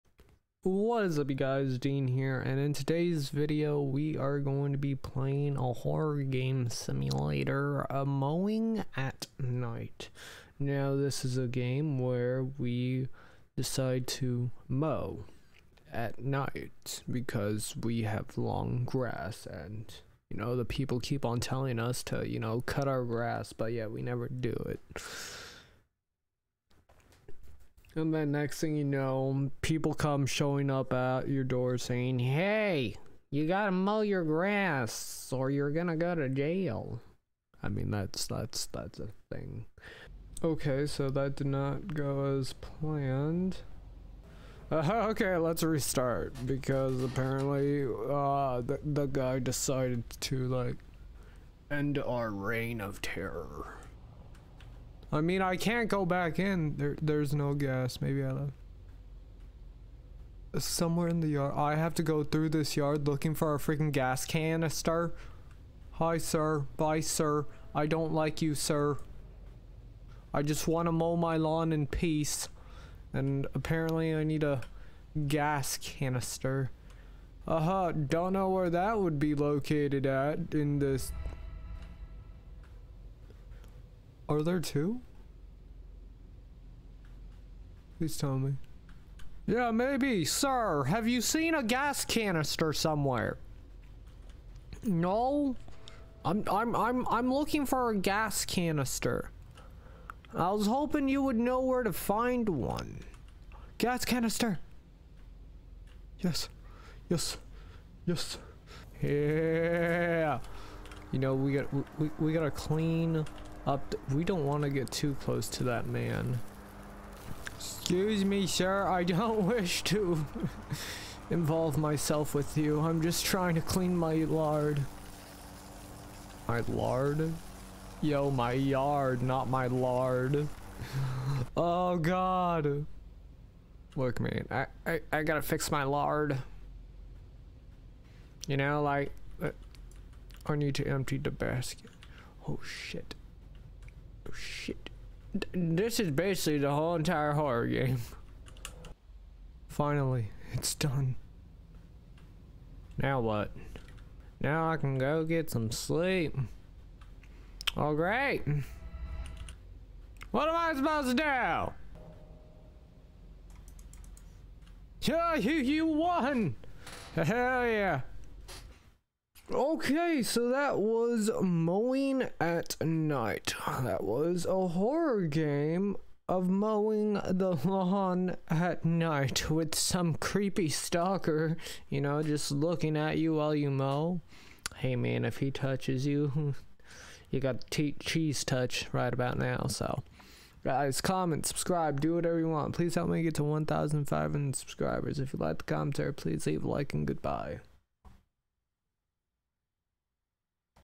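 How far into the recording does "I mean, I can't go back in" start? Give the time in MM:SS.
00:55.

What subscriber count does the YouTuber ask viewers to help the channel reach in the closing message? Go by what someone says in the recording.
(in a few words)
1,500.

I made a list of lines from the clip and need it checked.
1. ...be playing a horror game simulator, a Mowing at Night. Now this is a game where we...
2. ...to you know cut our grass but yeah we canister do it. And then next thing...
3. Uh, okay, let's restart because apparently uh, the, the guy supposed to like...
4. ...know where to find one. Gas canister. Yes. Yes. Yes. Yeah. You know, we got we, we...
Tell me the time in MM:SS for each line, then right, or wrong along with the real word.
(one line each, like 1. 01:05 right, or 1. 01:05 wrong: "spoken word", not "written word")
1. 00:04 right
2. 00:22 wrong: "never", not "canister"
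3. 00:44 wrong: "decided", not "supposed"
4. 01:41 right.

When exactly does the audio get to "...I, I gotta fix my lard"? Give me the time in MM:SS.
02:14.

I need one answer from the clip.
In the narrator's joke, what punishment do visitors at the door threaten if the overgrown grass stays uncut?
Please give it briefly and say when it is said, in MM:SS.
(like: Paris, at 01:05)
Jail, at 00:36.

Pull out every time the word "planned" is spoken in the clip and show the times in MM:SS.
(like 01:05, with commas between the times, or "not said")
00:42.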